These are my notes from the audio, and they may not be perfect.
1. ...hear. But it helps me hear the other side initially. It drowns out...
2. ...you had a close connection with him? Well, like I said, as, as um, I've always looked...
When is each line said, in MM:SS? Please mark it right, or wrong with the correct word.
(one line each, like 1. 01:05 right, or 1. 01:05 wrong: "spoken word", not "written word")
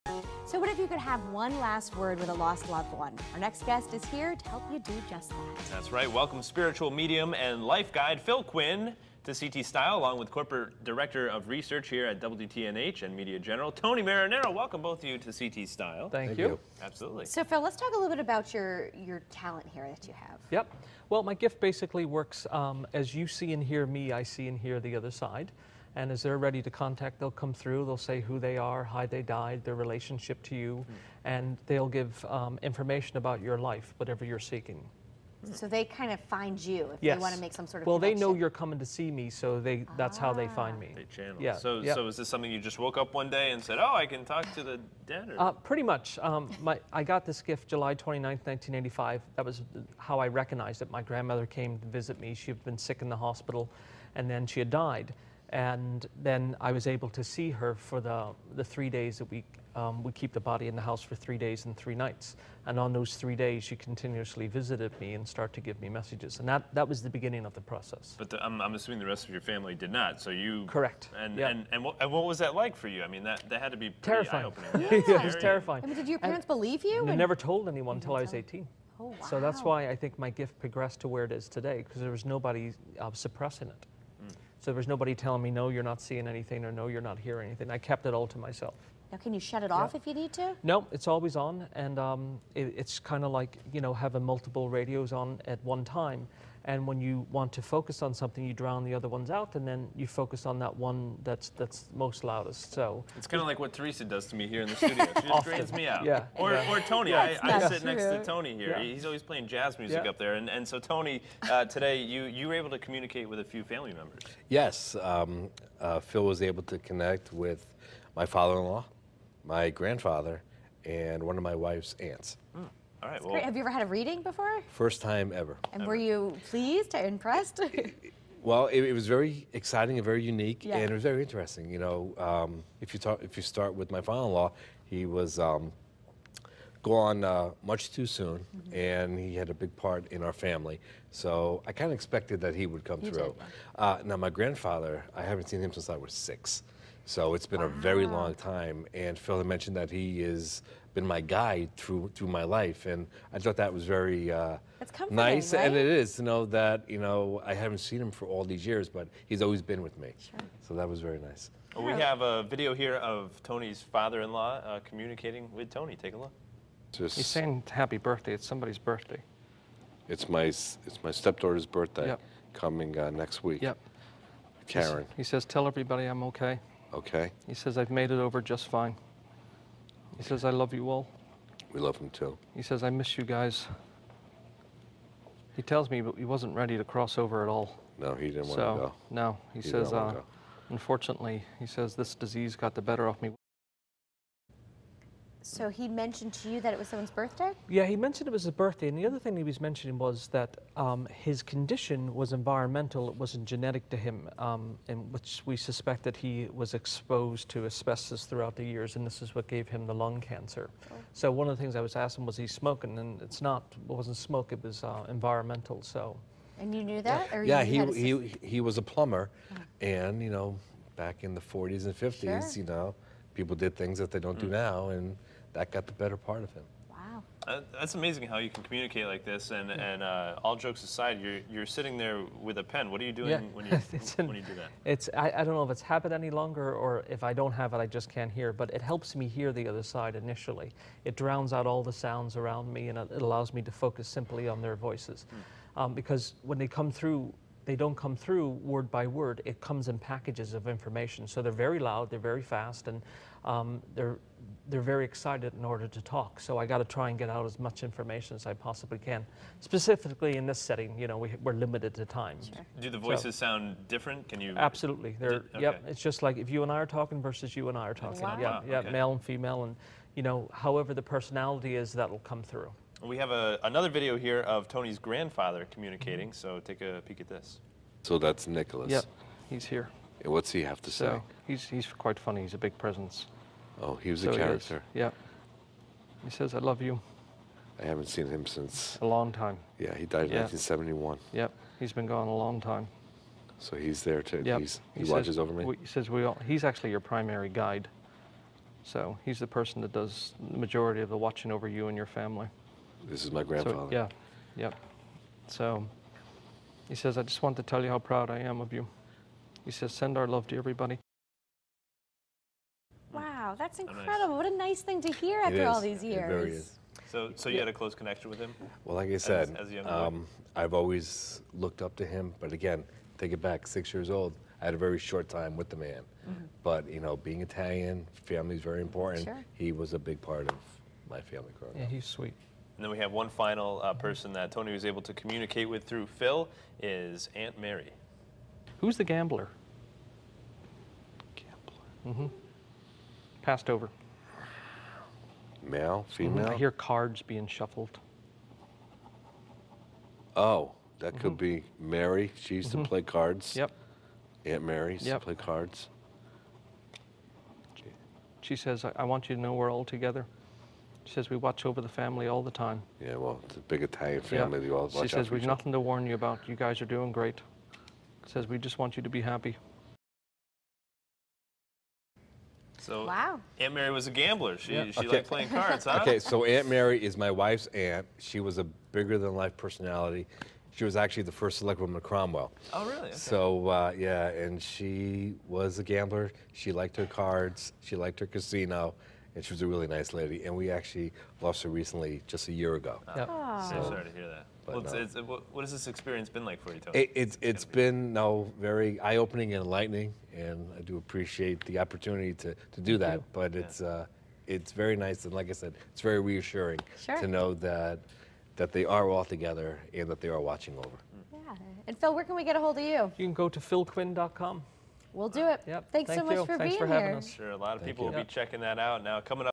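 1. 03:58 right
2. 05:17 right.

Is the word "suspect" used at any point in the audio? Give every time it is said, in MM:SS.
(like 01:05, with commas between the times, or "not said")
03:25.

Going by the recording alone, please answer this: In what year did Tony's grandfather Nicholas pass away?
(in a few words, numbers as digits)
1971.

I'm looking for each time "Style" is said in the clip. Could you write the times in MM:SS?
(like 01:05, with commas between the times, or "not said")
00:09, 00:15.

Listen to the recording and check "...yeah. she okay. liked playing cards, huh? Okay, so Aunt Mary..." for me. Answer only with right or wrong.
right.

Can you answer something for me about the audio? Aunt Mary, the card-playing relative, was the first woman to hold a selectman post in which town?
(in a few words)
Cromwell.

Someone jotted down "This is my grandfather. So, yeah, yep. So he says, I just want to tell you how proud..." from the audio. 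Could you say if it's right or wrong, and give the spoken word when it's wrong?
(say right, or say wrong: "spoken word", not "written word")
right.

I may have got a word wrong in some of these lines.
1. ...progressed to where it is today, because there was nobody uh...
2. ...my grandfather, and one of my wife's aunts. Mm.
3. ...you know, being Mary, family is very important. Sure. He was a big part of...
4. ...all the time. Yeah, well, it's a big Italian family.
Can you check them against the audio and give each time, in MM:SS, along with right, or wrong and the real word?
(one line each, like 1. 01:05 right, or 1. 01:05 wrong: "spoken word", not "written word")
1. 01:20 right
2. 01:59 right
3. 05:26 wrong: "Italian", not "Mary"
4. 06:02 right.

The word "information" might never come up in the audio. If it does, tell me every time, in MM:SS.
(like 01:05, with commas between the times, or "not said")
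00:32, 04:10, 04:17.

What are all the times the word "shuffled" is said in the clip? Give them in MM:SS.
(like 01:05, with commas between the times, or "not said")
05:47.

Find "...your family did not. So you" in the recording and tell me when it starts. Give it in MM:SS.
01:09.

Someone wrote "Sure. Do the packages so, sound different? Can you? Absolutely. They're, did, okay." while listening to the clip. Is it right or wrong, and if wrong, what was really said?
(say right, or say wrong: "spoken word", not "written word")
wrong: "voices", not "packages".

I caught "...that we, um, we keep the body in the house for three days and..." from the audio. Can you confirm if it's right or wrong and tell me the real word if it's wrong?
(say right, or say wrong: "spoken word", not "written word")
right.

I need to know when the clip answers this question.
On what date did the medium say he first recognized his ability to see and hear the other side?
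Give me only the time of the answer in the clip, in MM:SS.
00:47.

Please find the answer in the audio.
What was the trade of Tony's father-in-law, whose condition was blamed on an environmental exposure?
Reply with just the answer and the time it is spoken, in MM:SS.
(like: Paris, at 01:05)
plumber, at 03:38.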